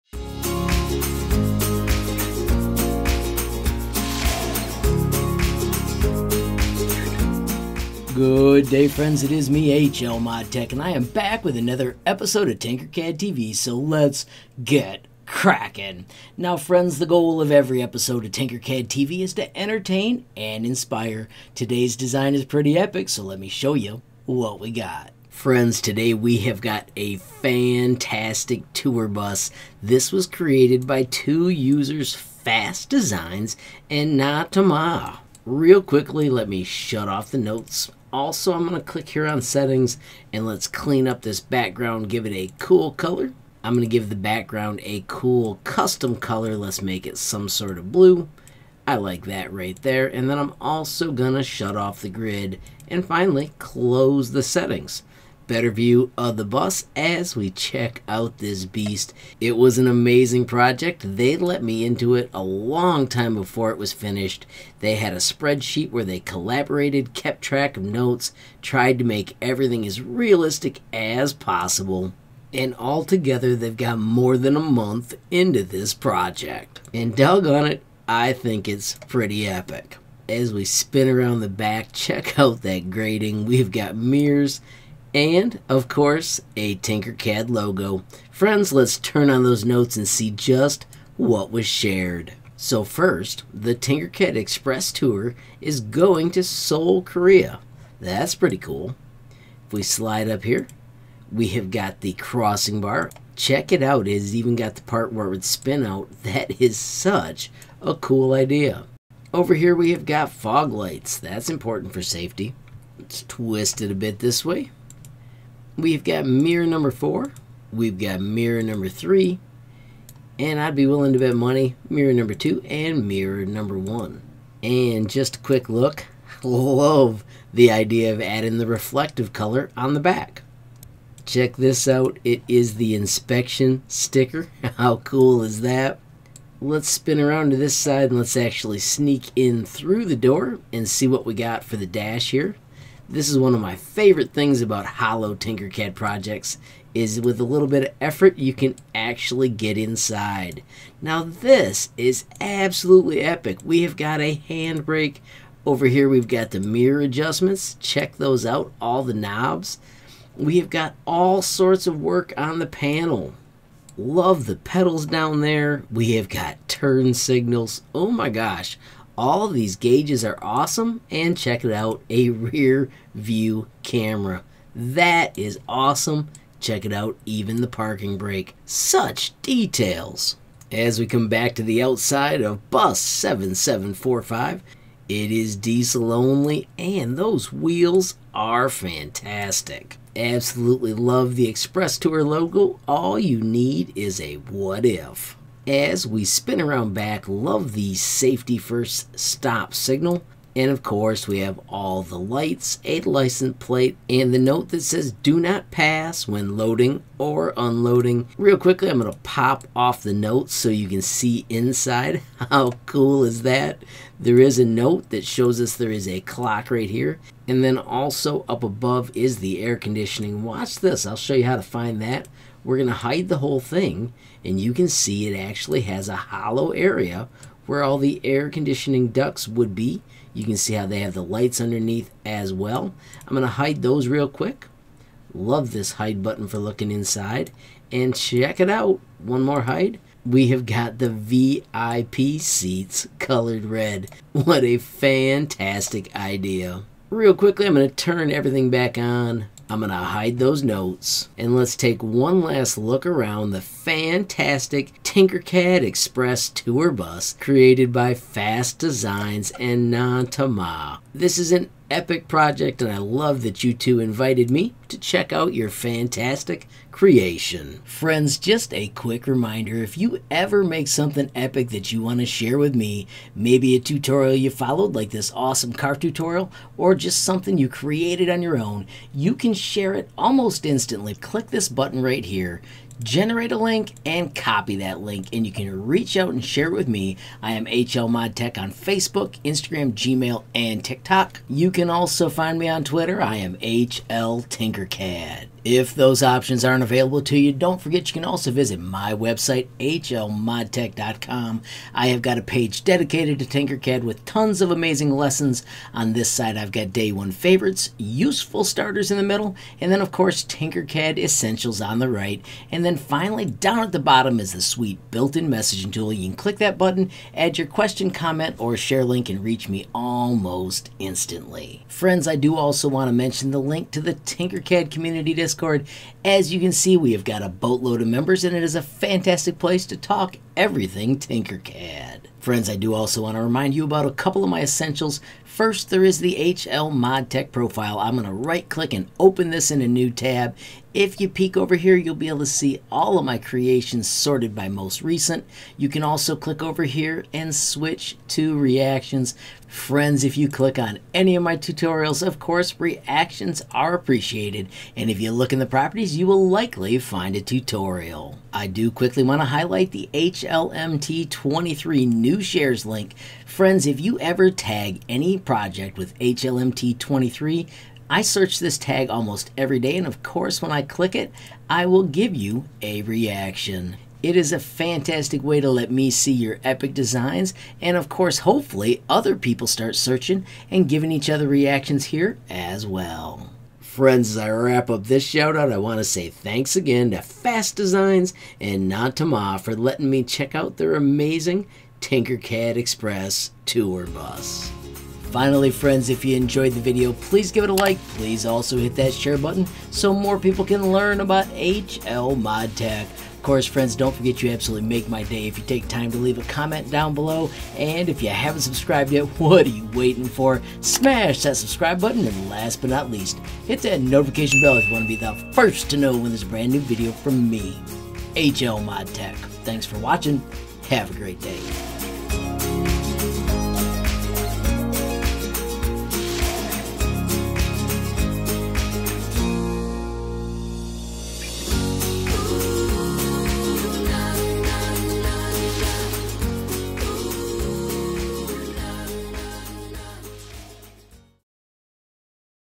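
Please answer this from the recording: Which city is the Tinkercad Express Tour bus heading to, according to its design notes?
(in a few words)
Seoul, Korea.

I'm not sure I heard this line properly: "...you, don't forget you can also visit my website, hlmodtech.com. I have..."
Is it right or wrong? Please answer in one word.
right.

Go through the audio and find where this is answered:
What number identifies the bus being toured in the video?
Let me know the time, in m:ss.
3:02.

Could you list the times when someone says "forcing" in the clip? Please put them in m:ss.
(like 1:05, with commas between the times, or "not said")
not said.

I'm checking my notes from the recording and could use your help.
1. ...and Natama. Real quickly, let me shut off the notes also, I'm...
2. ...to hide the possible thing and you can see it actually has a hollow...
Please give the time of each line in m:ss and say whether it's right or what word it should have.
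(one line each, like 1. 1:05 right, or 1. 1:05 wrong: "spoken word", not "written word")
1. 0:33 right
2. 3:42 wrong: "whole", not "possible".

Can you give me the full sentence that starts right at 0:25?
Friends, today we have got a fantastic tour bus.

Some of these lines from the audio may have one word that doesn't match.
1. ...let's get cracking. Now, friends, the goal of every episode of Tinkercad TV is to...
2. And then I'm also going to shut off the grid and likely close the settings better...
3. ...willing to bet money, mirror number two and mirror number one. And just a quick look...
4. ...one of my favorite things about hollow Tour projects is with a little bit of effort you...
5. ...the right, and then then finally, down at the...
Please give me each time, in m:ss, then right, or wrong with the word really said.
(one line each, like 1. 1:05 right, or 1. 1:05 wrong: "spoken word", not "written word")
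1. 0:13 right
2. 0:50 wrong: "finally", not "likely"
3. 2:00 right
4. 2:23 wrong: "Tinkercad", not "Tour"
5. 5:11 right.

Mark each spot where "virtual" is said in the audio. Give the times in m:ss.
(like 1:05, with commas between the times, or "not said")
not said.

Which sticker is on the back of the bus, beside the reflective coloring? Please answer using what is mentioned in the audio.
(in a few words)
Inspection sticker.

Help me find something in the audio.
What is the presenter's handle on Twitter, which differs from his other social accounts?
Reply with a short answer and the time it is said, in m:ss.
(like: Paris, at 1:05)
HL Tinkercad, at 4:53.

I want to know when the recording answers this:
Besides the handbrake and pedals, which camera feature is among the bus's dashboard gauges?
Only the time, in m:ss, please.
2:52.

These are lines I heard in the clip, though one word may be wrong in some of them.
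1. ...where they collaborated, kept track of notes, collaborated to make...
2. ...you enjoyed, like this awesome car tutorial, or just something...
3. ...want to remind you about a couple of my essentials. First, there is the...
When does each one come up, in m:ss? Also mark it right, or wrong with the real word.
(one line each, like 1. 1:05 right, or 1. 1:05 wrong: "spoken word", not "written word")
1. 1:05 wrong: "tried", not "collaborated"
2. 4:34 wrong: "followed", not "enjoyed"
3. 5:33 right.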